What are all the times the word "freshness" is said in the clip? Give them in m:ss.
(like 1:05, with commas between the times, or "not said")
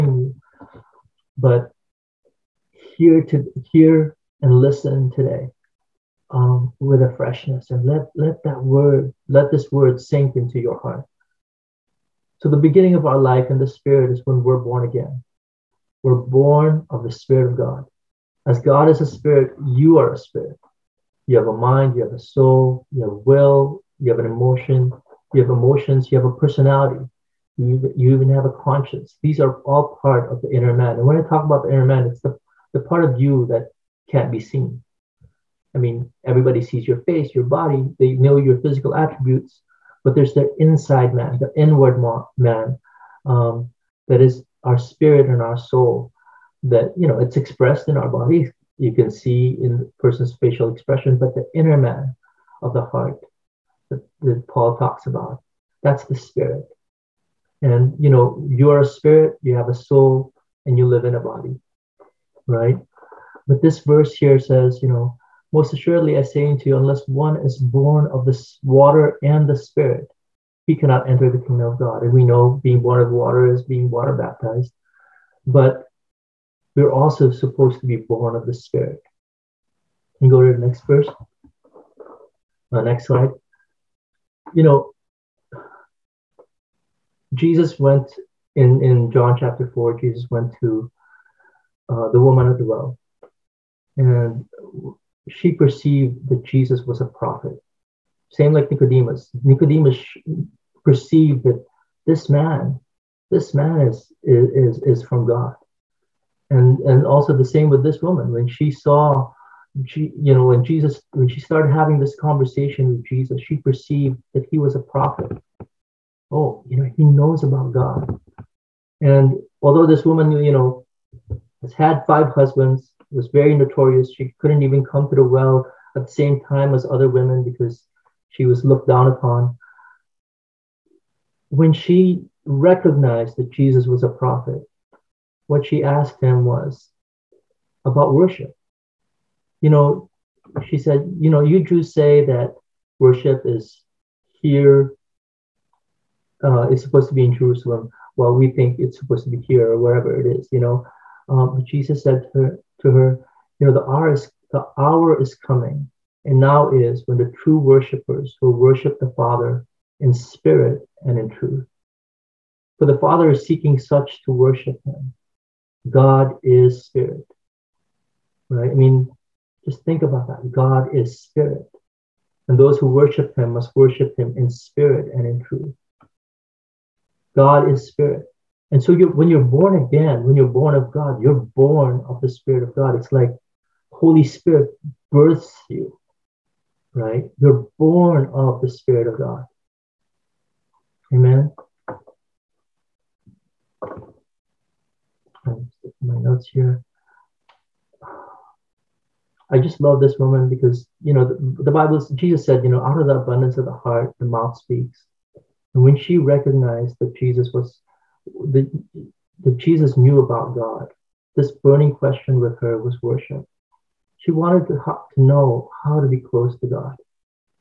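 0:07.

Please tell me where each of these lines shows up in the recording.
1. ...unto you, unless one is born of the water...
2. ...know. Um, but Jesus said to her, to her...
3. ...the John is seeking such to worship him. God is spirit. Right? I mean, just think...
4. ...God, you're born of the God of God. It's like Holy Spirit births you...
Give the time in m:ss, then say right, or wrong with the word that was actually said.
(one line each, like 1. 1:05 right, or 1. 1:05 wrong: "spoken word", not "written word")
1. 1:06 right
2. 2:30 right
3. 2:42 wrong: "Father", not "John"
4. 3:00 wrong: "Spirit", not "God".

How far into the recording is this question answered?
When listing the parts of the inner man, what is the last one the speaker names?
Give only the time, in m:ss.
0:28.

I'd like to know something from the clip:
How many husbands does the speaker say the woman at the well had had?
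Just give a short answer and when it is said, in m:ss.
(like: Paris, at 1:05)
5, at 2:02.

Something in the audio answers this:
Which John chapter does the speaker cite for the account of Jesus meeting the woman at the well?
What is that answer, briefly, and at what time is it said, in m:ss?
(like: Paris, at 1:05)
Chapter 4, at 1:29.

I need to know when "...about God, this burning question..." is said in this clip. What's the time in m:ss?
3:30.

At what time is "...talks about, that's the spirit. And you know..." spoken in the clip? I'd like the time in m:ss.
0:54.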